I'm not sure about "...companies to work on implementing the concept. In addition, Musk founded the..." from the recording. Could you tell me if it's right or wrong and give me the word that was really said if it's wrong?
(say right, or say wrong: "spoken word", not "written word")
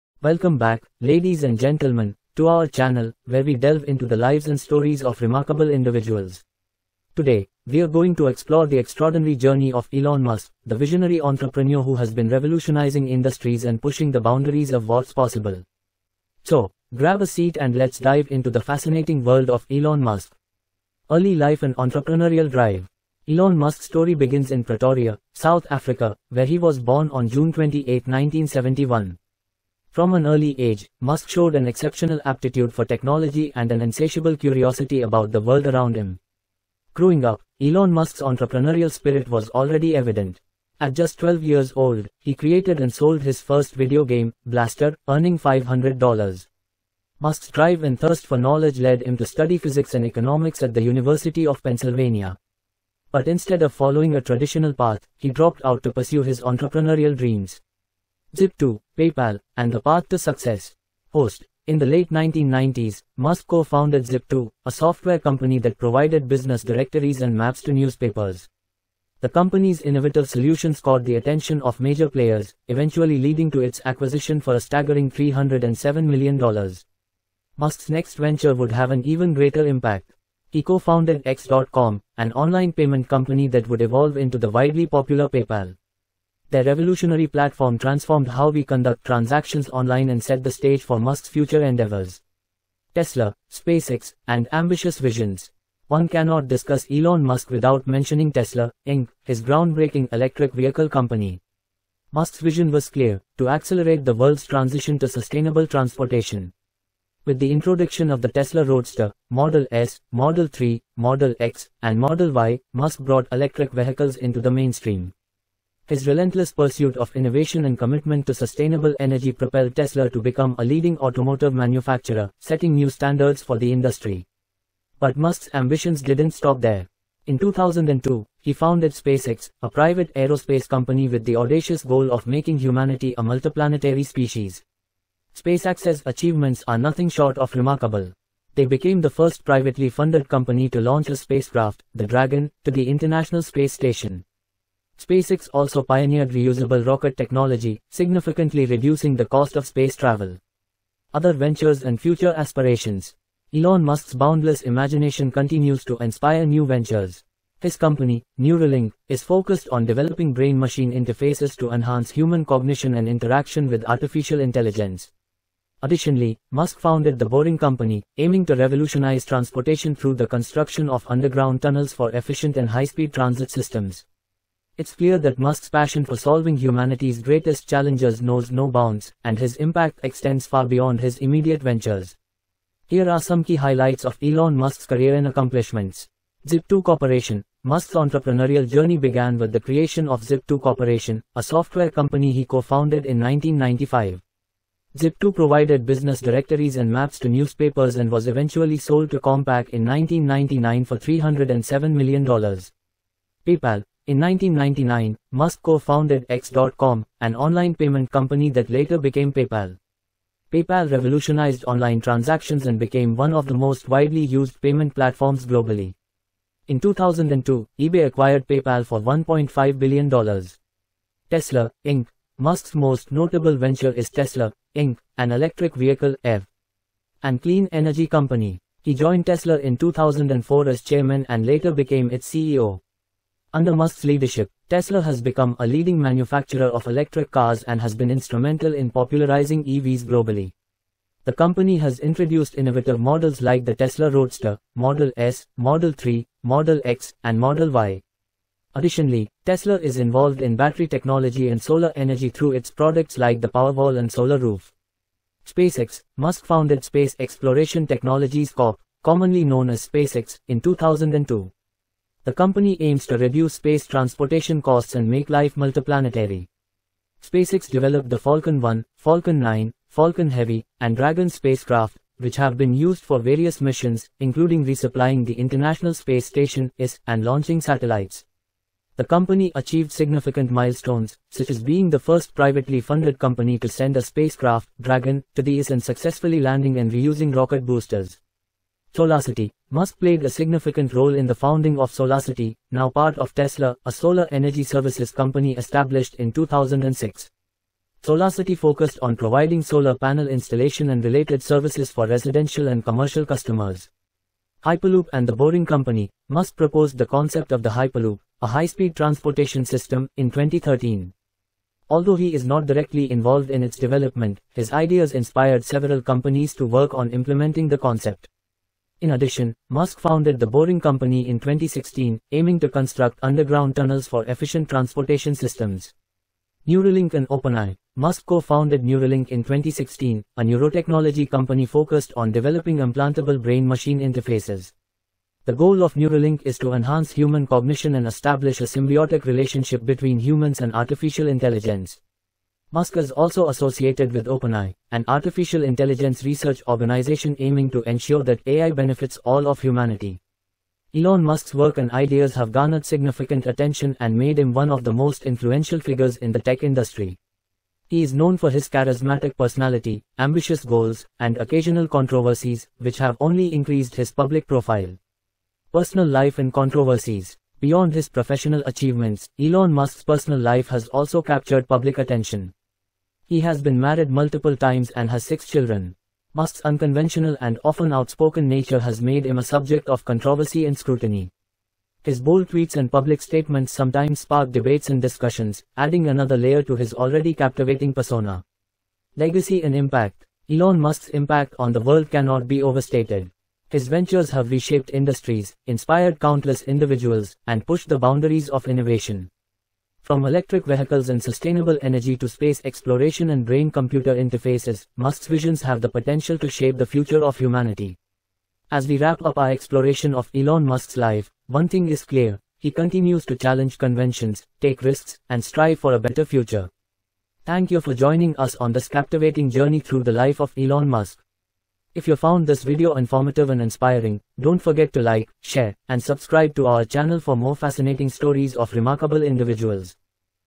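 right.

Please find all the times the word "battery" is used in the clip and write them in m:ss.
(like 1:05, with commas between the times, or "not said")
4:10.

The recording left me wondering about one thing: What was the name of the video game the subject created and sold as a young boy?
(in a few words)
Blaster.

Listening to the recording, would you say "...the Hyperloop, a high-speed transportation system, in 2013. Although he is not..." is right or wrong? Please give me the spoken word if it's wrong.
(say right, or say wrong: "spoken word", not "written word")
right.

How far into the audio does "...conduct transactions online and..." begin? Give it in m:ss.
1:28.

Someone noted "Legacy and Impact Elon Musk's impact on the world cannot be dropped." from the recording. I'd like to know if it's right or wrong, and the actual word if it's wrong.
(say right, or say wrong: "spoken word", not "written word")
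wrong: "overstated", not "dropped".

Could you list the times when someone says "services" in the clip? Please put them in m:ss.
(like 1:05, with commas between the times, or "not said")
4:54, 5:01.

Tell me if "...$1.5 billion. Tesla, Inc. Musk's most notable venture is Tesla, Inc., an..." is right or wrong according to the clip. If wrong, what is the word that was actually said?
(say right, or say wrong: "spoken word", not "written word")
right.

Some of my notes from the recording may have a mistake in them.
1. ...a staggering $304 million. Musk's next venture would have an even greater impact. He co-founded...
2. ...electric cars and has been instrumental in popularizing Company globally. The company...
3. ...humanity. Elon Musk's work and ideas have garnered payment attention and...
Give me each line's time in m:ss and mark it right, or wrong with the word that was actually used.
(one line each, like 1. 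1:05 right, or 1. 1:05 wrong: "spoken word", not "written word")
1. 1:14 wrong: "307", not "304"
2. 3:56 wrong: "EVs", not "Company"
3. 5:49 wrong: "significant", not "payment".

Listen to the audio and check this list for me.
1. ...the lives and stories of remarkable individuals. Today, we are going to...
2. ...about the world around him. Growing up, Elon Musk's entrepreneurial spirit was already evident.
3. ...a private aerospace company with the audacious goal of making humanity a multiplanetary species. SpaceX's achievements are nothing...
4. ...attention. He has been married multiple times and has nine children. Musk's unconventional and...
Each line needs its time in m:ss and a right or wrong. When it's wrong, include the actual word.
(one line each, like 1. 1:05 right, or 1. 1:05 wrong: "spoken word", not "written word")
1. 0:04 right
2. 0:35 right
3. 2:09 right
4. 6:11 wrong: "six", not "nine".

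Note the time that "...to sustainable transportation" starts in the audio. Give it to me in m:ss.
1:44.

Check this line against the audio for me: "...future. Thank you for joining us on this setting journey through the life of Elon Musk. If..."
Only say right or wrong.
wrong.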